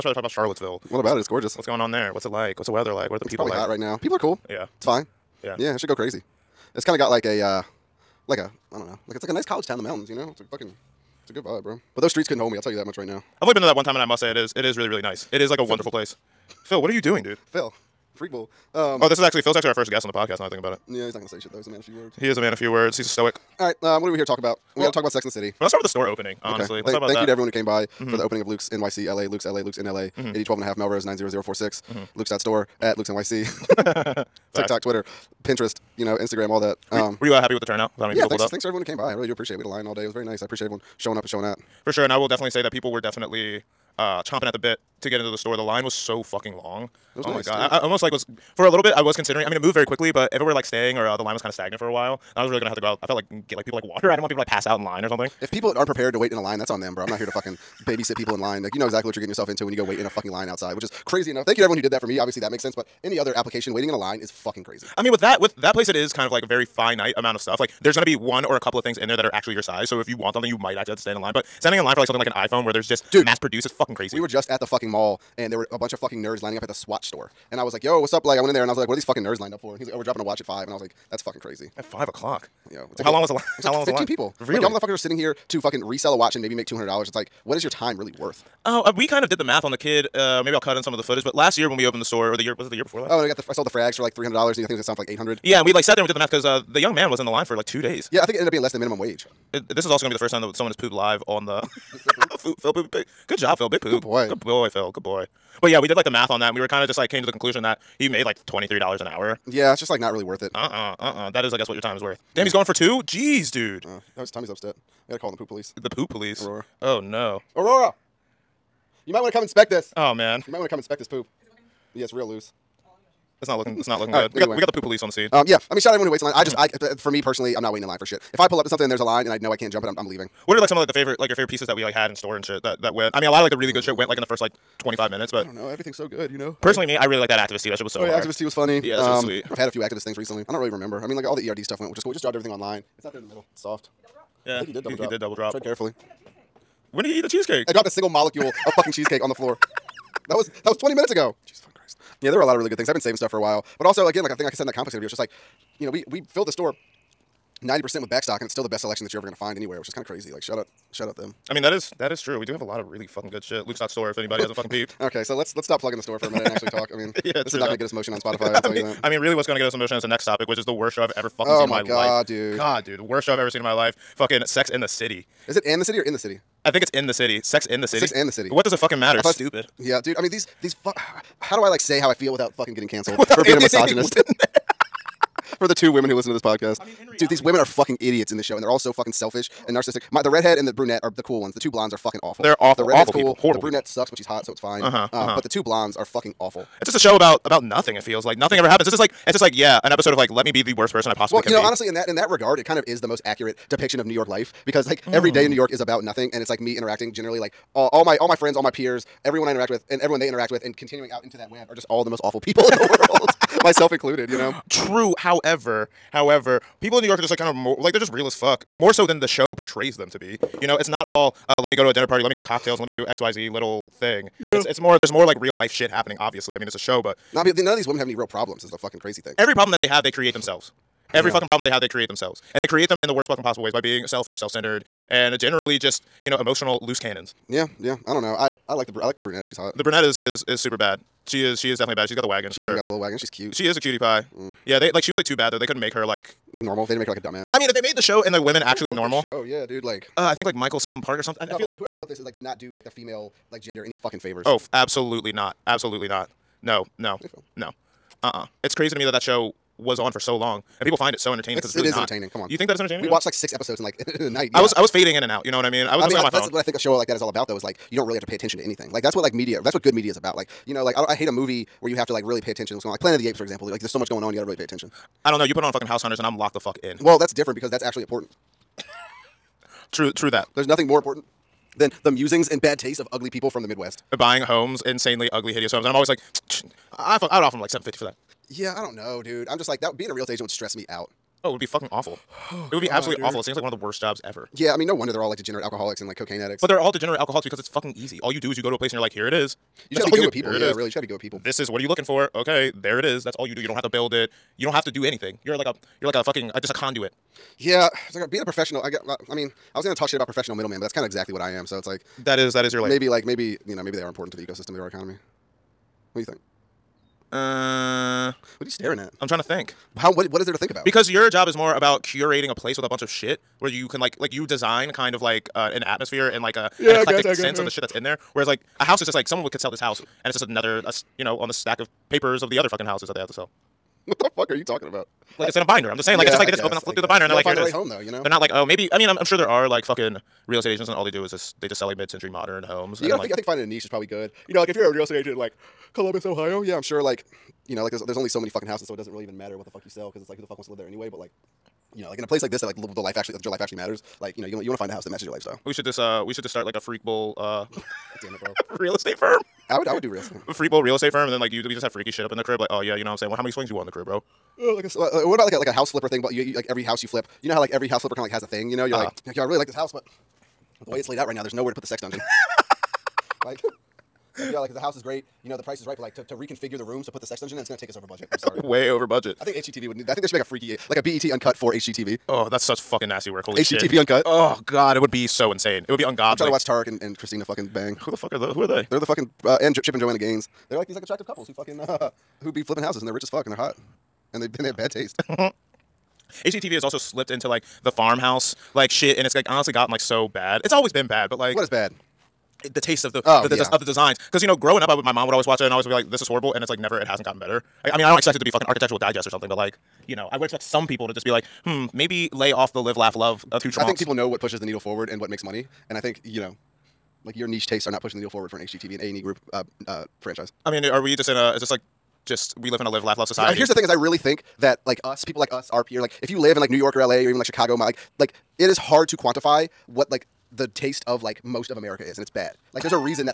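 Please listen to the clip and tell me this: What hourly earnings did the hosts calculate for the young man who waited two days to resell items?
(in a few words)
$23 an hour.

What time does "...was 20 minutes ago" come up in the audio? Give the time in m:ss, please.
2:30.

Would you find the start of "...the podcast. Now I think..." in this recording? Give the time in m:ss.
0:20.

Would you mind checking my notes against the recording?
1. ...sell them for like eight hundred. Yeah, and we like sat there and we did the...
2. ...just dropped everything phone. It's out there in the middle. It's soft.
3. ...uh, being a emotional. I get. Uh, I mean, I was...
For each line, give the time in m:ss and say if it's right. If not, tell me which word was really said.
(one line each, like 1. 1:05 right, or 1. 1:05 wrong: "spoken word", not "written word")
1. 1:34 right
2. 2:22 wrong: "online", not "phone"
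3. 5:08 wrong: "professional", not "emotional".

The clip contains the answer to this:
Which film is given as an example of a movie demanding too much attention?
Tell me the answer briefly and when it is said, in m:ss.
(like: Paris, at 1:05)
Planet of the Apes, at 4:33.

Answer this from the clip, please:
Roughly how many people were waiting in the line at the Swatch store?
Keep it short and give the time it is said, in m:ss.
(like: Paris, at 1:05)
15, at 1:23.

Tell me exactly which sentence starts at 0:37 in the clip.
With how many yeah, people thanks, pulled up?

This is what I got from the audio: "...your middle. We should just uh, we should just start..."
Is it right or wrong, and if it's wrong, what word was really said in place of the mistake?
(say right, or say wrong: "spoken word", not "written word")
wrong: "lifestyle", not "middle".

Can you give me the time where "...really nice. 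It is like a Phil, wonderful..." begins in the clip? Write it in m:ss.
0:14.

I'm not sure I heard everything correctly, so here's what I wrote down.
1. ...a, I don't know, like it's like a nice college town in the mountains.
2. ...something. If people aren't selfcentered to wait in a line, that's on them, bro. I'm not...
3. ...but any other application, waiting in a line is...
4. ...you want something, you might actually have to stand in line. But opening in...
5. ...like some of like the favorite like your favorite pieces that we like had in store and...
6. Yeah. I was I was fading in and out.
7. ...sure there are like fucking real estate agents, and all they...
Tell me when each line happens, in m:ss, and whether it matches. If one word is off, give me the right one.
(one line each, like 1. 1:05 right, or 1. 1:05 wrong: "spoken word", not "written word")
1. 0:08 right
2. 0:55 wrong: "prepared", not "selfcentered"
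3. 1:02 right
4. 1:10 wrong: "standing", not "opening"
5. 2:10 right
6. 4:24 right
7. 5:39 right.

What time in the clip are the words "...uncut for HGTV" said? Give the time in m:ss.
6:21.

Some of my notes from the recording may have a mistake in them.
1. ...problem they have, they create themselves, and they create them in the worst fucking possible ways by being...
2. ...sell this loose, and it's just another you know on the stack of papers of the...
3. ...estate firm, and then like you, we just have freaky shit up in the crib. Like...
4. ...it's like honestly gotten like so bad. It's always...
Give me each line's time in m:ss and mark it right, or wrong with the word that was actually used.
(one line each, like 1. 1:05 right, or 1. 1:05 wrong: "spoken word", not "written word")
1. 3:51 right
2. 5:29 wrong: "house", not "loose"
3. 6:00 right
4. 6:39 right.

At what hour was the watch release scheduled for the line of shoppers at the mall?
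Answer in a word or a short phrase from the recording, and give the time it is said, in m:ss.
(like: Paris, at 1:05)
5, at 1:19.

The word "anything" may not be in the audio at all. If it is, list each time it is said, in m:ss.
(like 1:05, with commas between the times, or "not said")
4:28, 5:05.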